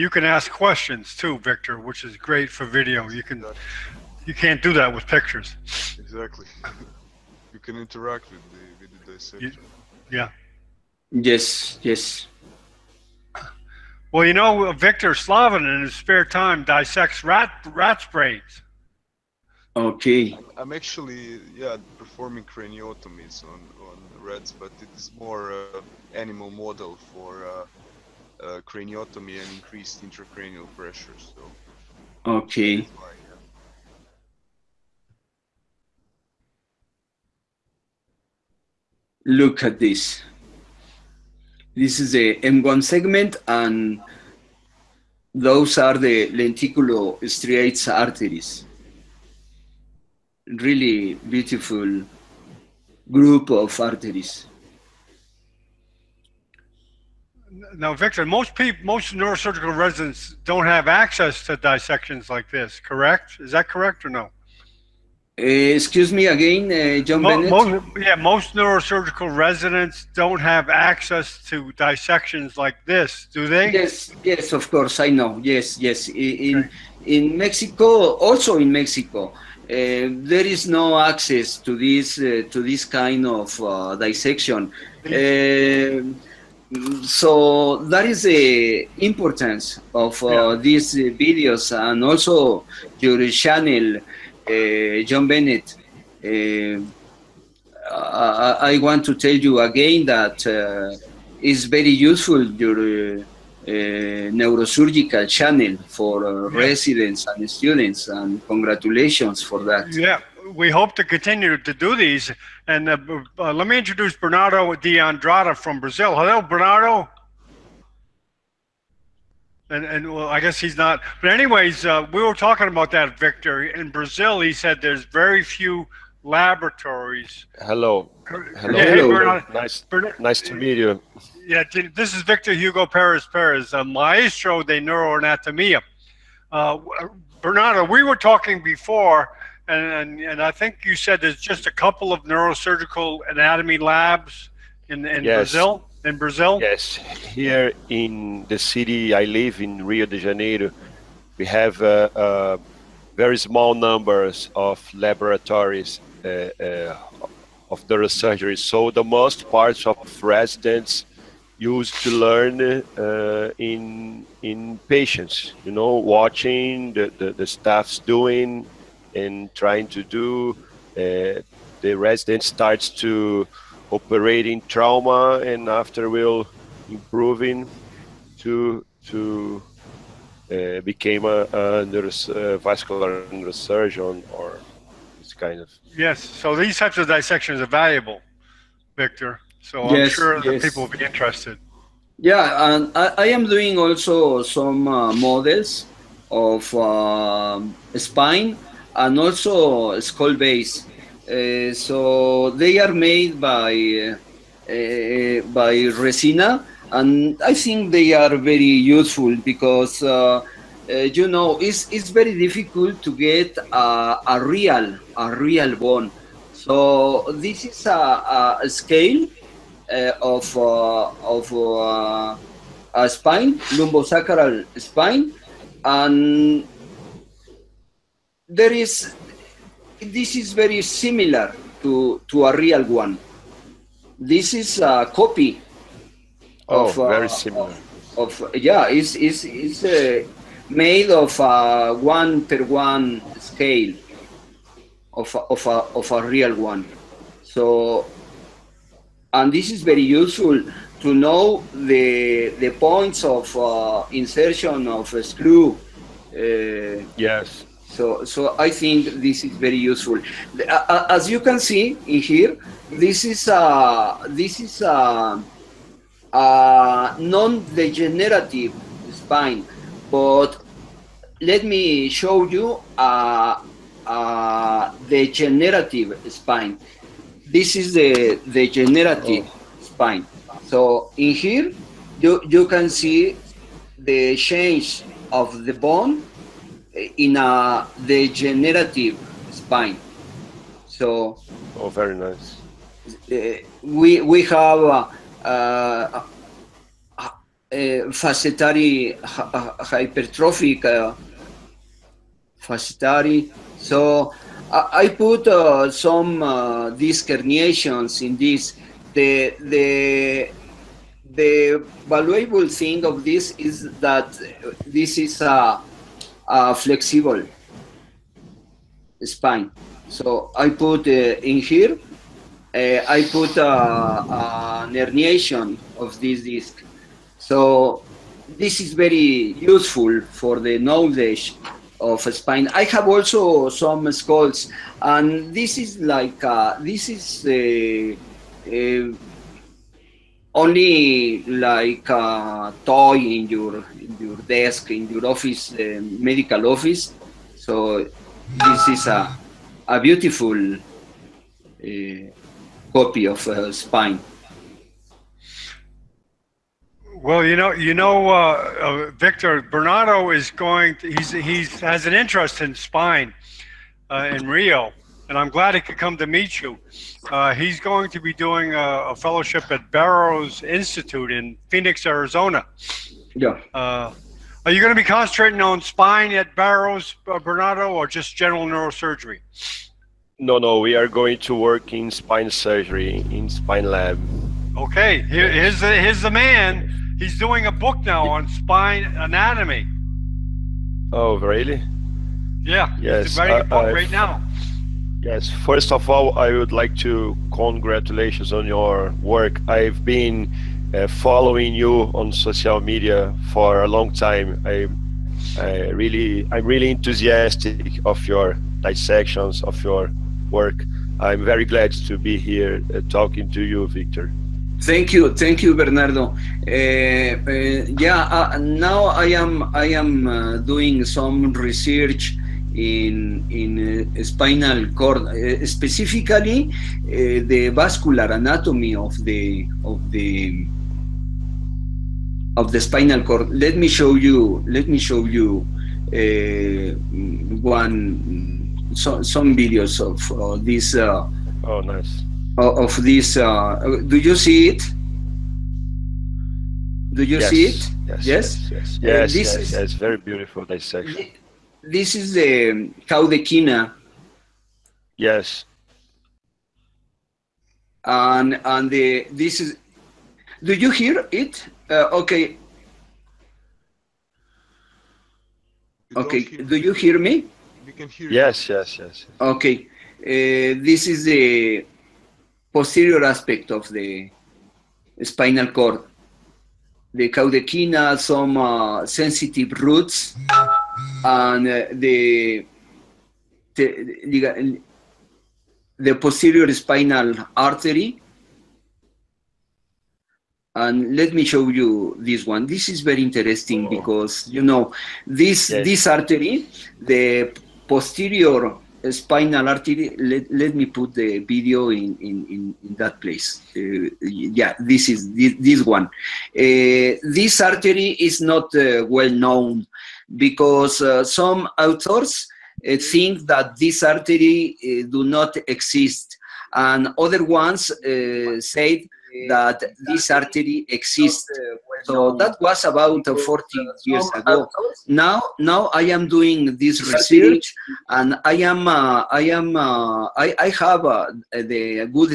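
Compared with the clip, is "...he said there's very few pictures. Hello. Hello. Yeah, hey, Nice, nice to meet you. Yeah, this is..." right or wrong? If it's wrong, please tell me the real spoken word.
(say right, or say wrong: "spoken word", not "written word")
wrong: "laboratories", not "pictures".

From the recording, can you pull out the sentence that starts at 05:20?
So I put uh, in here, uh, I put uh, an herniation of this disc.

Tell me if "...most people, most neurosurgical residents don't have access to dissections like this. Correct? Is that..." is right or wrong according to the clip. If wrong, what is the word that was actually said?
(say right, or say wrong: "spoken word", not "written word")
right.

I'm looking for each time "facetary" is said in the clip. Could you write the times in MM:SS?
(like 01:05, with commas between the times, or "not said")
04:58, 05:02.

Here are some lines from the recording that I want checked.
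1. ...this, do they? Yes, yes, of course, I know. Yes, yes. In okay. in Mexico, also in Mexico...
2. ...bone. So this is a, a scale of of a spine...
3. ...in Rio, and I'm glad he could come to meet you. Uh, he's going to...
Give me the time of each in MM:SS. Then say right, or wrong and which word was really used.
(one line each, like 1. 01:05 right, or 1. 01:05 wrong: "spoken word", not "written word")
1. 01:12 right
2. 03:35 right
3. 06:04 right.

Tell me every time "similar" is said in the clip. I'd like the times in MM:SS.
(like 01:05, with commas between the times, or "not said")
03:50, 03:57.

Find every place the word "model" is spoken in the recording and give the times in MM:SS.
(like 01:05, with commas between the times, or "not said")
00:26, 03:15.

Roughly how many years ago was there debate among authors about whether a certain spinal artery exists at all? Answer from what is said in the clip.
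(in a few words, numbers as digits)
40.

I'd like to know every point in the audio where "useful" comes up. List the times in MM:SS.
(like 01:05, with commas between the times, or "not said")
01:41, 03:28, 04:10, 04:19, 05:29.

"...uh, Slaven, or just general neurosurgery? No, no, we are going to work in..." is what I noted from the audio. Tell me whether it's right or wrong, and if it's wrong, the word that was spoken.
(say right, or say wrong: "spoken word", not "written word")
wrong: "Bernardo", not "Slaven".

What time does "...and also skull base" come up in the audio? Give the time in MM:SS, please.
03:18.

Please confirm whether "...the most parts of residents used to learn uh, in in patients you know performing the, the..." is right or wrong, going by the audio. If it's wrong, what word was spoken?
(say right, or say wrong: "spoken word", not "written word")
wrong: "watching", not "performing".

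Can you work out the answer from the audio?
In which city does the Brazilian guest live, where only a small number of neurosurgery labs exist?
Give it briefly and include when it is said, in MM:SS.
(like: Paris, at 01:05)
Rio de Janeiro, at 02:29.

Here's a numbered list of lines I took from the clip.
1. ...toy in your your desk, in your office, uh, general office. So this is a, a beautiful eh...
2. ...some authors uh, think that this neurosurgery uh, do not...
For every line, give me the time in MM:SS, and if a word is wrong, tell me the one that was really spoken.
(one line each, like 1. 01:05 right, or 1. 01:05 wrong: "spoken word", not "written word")
1. 05:42 wrong: "medical", not "general"
2. 08:31 wrong: "artery", not "neurosurgery".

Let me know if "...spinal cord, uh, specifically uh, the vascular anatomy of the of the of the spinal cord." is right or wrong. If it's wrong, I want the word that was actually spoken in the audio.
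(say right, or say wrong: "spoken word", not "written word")
right.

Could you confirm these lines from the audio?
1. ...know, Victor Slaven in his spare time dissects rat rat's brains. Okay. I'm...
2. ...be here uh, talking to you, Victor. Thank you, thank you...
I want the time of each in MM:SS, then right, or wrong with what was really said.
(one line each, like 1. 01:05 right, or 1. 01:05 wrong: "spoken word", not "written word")
1. 00:14 right
2. 06:52 right.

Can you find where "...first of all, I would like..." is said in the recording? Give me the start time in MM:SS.
06:35.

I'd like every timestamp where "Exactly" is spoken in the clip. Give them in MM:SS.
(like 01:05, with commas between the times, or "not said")
00:05.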